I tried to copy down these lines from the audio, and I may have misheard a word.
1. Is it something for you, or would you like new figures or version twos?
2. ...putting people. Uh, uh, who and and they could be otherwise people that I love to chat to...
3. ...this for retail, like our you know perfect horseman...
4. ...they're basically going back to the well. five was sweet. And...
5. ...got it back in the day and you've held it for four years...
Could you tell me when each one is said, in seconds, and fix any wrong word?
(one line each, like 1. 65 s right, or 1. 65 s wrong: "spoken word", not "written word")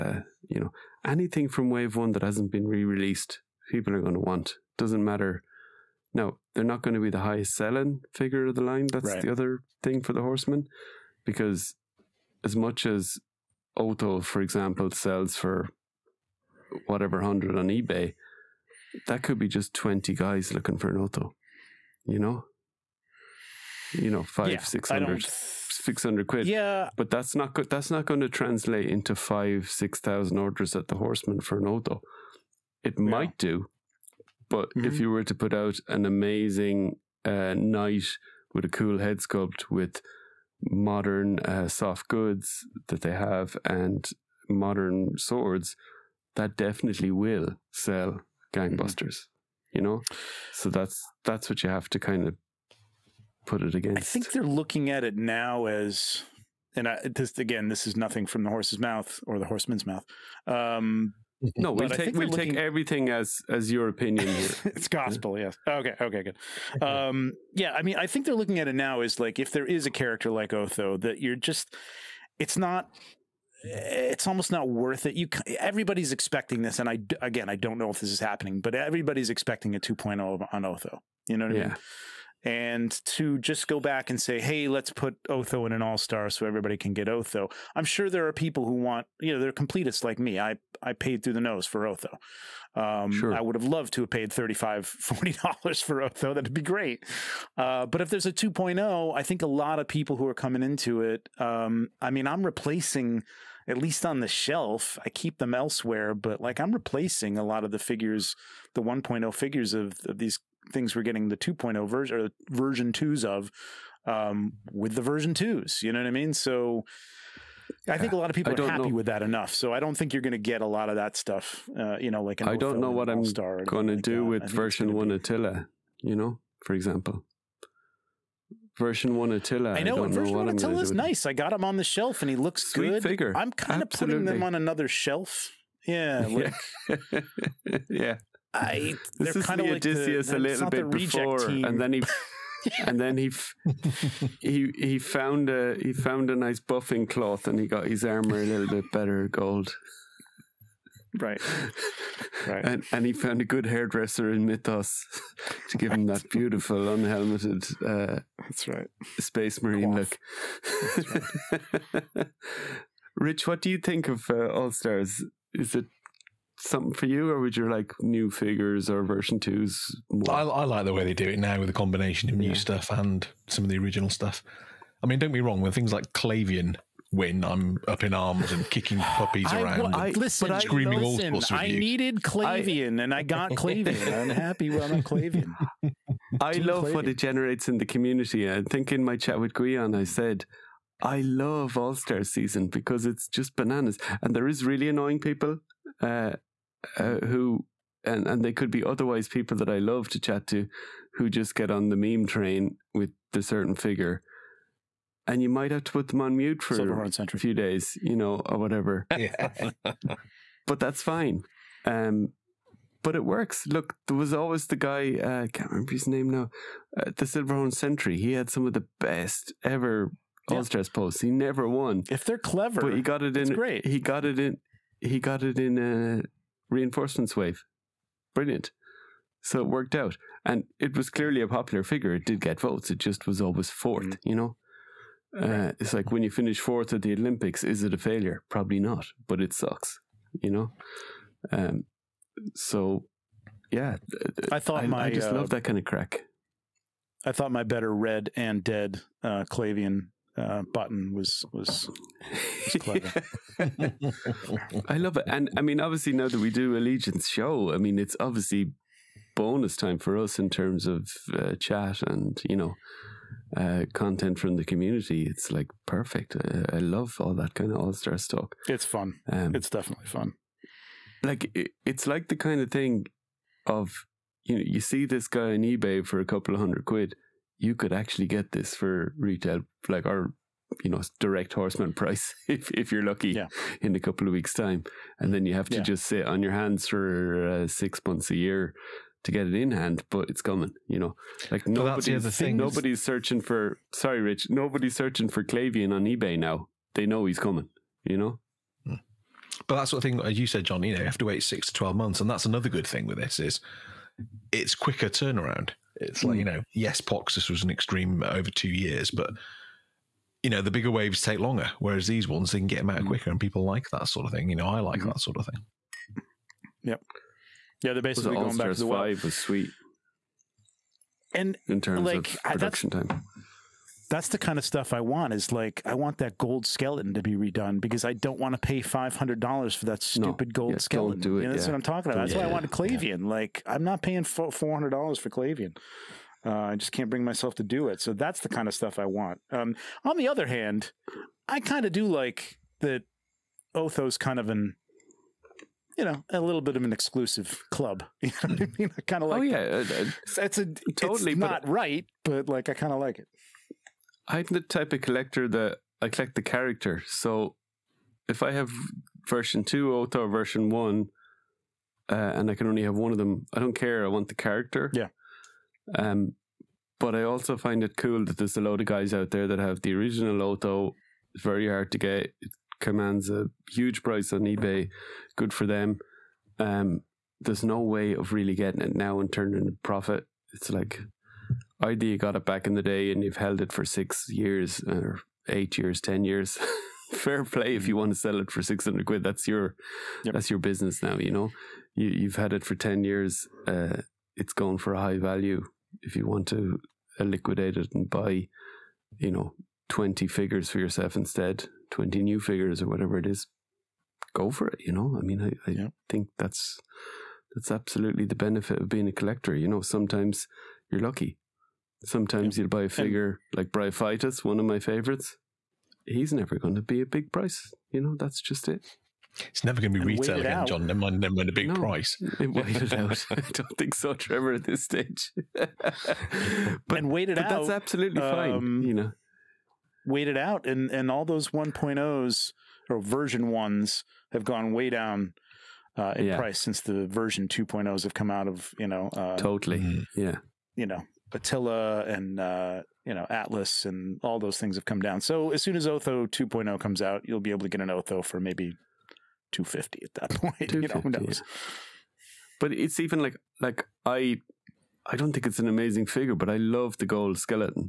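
1. 165 s right
2. 194 s wrong: "annoying", not "putting"
3. 278 s wrong: "direct", not "perfect"
4. 317 s right
5. 382 s wrong: "six", not "four".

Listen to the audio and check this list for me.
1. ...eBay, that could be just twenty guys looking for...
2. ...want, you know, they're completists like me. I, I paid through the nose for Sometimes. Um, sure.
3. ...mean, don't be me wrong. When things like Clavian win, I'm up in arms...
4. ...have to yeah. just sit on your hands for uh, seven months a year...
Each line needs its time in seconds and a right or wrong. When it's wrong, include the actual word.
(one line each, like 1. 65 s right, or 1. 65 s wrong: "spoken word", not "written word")
1. 17 s right
2. 88 s wrong: "Otho", not "Sometimes"
3. 175 s right
4. 285 s wrong: "six", not "seven".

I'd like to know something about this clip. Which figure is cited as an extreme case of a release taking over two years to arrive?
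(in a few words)
Poxxus.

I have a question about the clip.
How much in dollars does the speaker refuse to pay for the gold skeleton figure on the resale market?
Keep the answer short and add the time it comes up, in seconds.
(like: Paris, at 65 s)
500, at 328 s.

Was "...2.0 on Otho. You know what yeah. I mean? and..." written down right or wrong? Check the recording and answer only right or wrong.
right.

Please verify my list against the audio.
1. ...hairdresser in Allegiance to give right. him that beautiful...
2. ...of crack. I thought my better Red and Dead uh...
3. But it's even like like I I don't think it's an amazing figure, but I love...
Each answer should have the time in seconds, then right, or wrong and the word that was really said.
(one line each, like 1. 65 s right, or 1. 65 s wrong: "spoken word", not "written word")
1. 153 s wrong: "Mythos", not "Allegiance"
2. 245 s right
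3. 452 s right.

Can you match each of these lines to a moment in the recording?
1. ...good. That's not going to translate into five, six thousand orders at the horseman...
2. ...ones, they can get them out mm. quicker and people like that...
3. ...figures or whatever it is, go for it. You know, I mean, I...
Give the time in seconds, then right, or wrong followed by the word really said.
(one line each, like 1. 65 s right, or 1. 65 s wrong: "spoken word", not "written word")
1. 27 s right
2. 312 s right
3. 402 s right.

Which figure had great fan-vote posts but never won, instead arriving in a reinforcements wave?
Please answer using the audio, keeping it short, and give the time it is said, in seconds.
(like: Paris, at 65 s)
Silverhorn Sentry, at 217 s.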